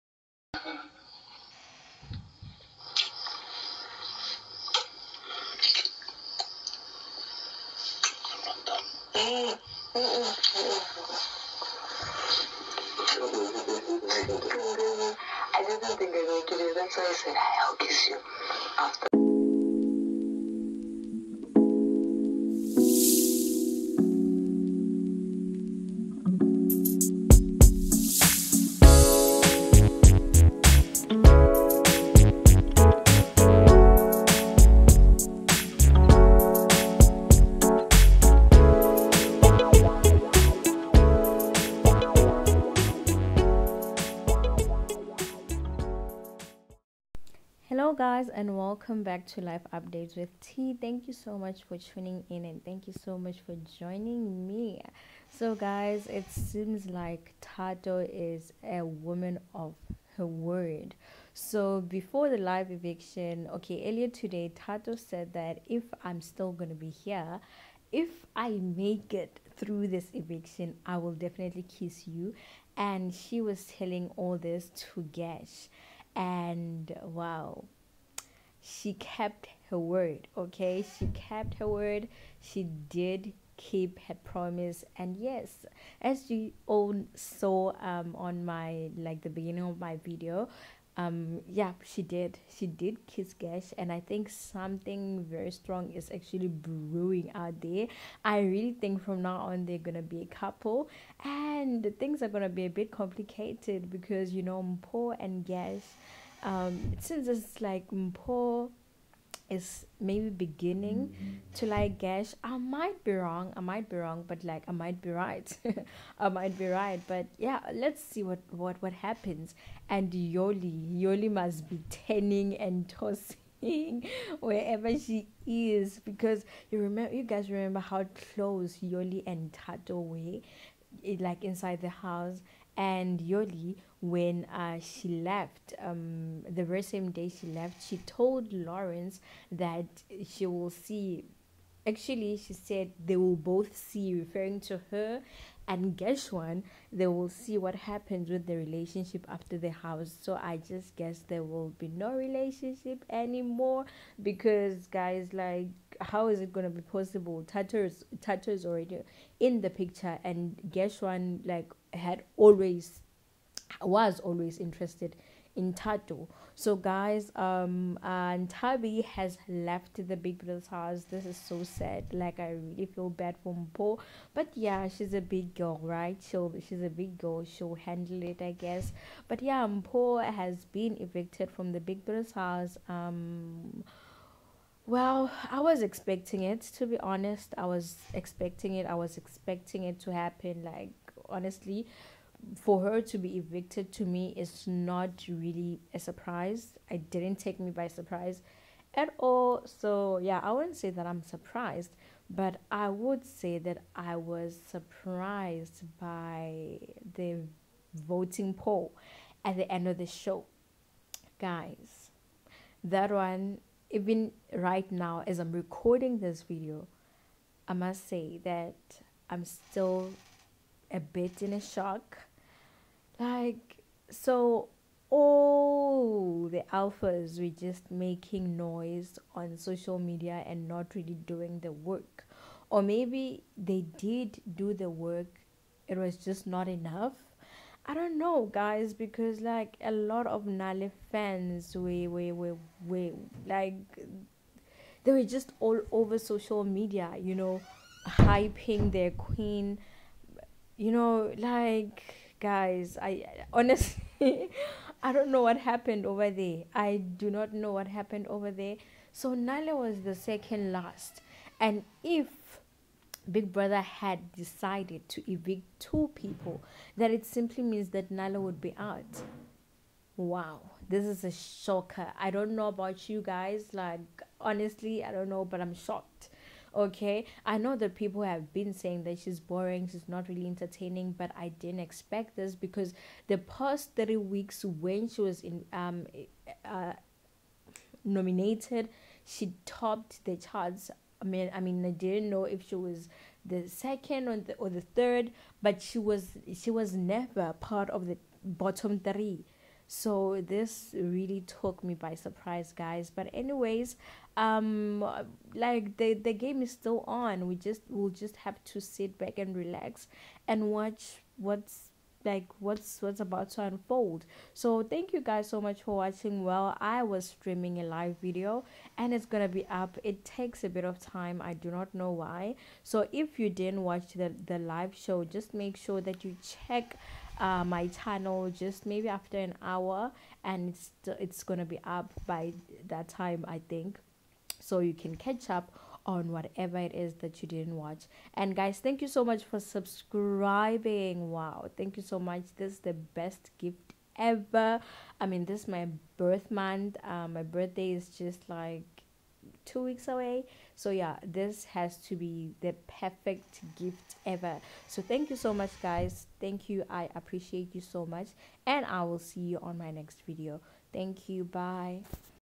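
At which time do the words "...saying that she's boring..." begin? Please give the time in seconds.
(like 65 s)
278 s.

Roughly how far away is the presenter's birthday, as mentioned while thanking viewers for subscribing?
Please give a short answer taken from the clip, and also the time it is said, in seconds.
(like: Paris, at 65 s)
two weeks, at 349 s.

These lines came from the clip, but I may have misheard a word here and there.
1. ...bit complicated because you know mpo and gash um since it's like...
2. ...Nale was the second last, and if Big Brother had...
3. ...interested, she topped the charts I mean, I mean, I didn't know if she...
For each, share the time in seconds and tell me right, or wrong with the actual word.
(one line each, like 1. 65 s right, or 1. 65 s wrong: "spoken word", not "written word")
1. 102 s right
2. 259 s right
3. 288 s wrong: "nominated", not "interested".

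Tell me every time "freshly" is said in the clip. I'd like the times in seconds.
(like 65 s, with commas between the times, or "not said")
not said.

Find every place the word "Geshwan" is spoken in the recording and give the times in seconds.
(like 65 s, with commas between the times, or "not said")
145 s, 160 s.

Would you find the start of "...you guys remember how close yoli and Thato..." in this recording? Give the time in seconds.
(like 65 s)
127 s.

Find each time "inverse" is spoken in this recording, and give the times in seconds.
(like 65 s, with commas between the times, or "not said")
not said.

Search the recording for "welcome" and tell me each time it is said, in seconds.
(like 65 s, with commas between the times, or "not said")
48 s.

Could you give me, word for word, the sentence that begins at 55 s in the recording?
So, guys, it seems like Thato is a woman of her word.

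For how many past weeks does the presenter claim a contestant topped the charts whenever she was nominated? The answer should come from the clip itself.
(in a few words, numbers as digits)
30.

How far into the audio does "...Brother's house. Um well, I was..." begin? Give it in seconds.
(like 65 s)
182 s.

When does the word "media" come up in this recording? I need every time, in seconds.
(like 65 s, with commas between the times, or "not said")
229 s, 246 s.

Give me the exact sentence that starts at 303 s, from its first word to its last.
But anyways, um, like the the game is still on.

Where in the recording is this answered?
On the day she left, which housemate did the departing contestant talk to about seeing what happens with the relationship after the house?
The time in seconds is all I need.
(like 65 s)
138 s.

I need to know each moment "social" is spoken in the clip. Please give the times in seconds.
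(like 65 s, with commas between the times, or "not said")
229 s, 246 s.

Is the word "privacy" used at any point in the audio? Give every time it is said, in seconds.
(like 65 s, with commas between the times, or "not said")
not said.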